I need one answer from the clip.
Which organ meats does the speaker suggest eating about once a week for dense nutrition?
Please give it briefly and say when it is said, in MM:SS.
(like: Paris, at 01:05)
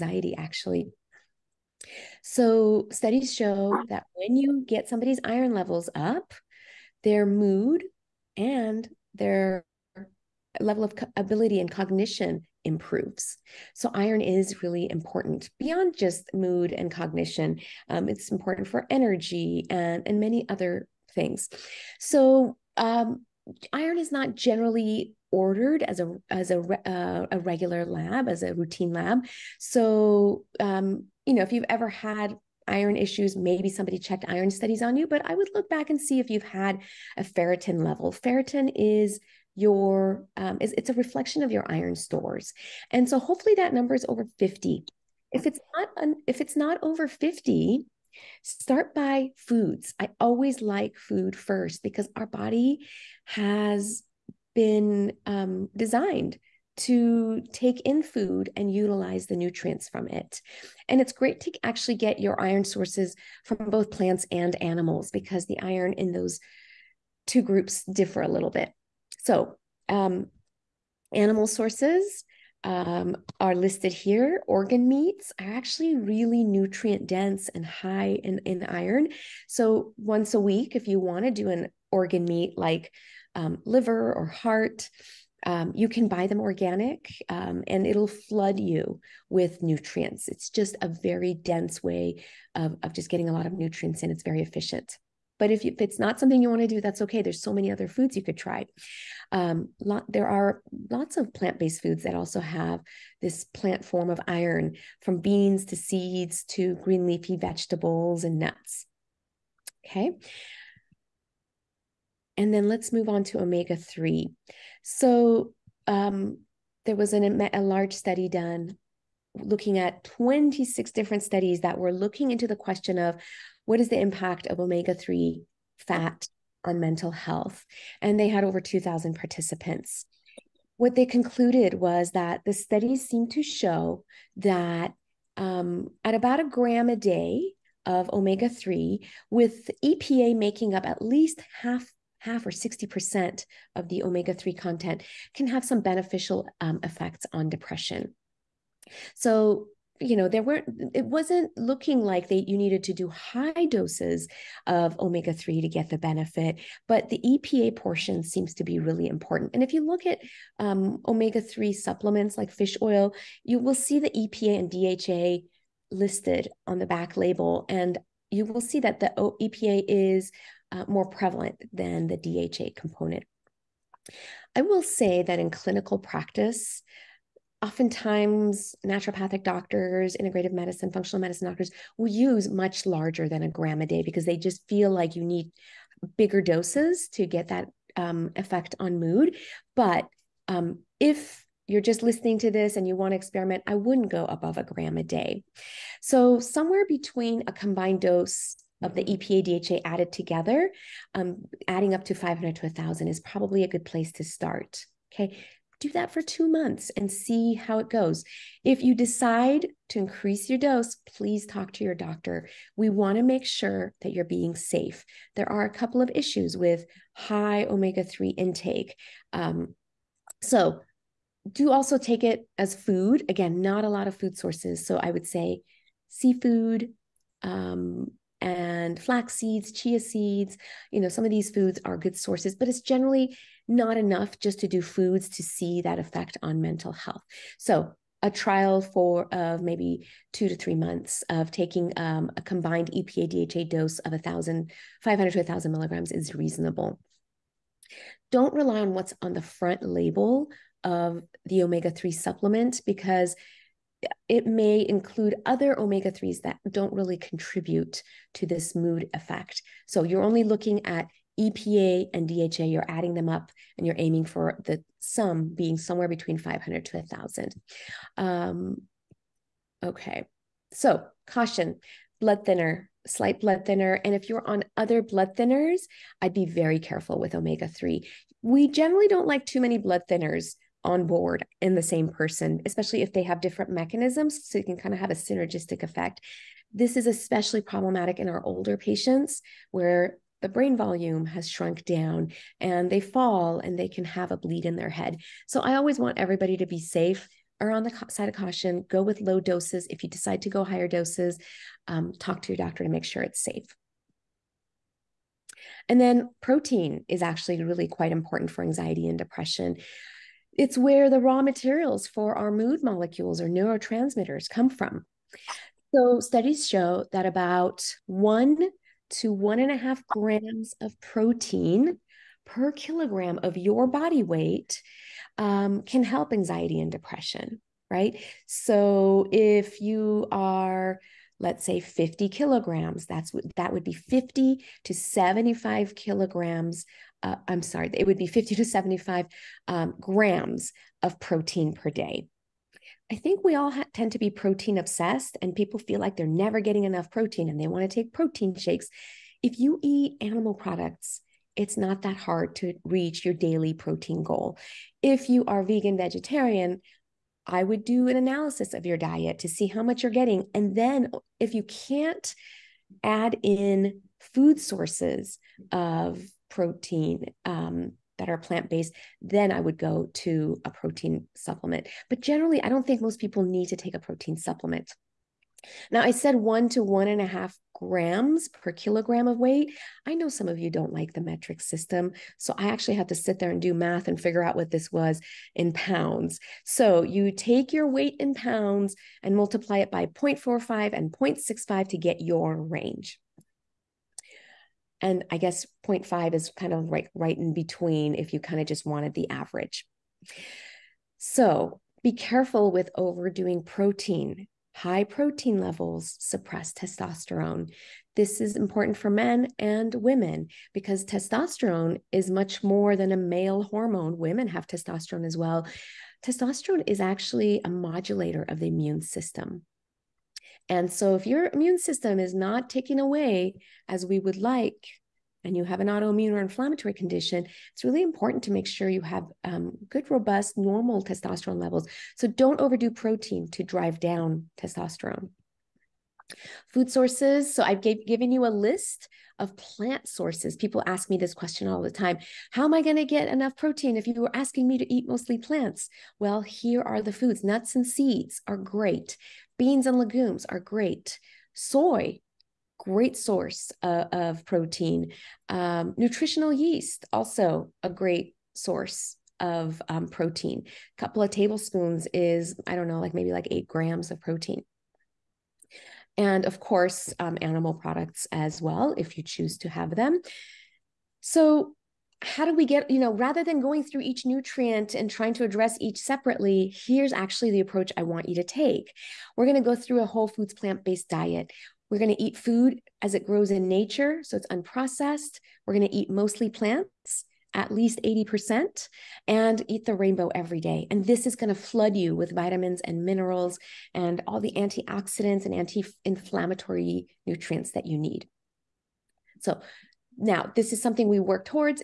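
liver or heart, at 01:23.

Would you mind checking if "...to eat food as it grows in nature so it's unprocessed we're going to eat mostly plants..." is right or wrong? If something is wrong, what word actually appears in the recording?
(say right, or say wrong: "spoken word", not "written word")
right.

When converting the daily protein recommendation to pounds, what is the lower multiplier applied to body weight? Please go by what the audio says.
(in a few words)
0.45.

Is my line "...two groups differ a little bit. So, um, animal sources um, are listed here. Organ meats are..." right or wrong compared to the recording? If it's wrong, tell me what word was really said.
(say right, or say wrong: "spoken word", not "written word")
right.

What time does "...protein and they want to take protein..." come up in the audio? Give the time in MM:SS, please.
05:47.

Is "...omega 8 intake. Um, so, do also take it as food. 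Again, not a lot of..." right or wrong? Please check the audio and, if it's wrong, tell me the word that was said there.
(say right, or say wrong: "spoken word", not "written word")
wrong: "3", not "8".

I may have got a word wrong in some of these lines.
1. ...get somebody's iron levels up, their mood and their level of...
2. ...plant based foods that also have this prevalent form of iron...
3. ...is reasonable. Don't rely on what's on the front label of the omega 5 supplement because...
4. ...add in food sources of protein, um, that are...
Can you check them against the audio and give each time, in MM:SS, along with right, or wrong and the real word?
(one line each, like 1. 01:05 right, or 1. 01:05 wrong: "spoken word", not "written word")
1. 00:04 right
2. 01:41 wrong: "plant", not "prevalent"
3. 04:06 wrong: "3", not "5"
4. 06:03 right.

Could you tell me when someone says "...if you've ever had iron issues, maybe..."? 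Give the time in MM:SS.
00:31.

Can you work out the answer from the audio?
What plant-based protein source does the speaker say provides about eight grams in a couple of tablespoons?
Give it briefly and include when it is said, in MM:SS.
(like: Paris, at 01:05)
nutritional yeast, at 07:35.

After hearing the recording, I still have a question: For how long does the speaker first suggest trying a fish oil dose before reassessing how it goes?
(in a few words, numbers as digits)
two months.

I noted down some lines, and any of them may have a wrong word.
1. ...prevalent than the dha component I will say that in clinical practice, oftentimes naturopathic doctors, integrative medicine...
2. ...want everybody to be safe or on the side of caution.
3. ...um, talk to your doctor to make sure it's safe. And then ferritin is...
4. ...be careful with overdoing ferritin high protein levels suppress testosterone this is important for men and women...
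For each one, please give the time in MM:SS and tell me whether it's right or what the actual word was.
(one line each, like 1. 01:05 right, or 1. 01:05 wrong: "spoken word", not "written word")
1. 02:51 right
2. 04:55 right
3. 05:01 wrong: "protein", not "ferritin"
4. 06:42 wrong: "protein", not "ferritin".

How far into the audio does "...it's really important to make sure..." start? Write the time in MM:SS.
07:07.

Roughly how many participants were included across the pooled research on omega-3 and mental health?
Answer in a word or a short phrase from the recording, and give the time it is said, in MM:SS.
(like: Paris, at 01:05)
over 2,000, at 02:08.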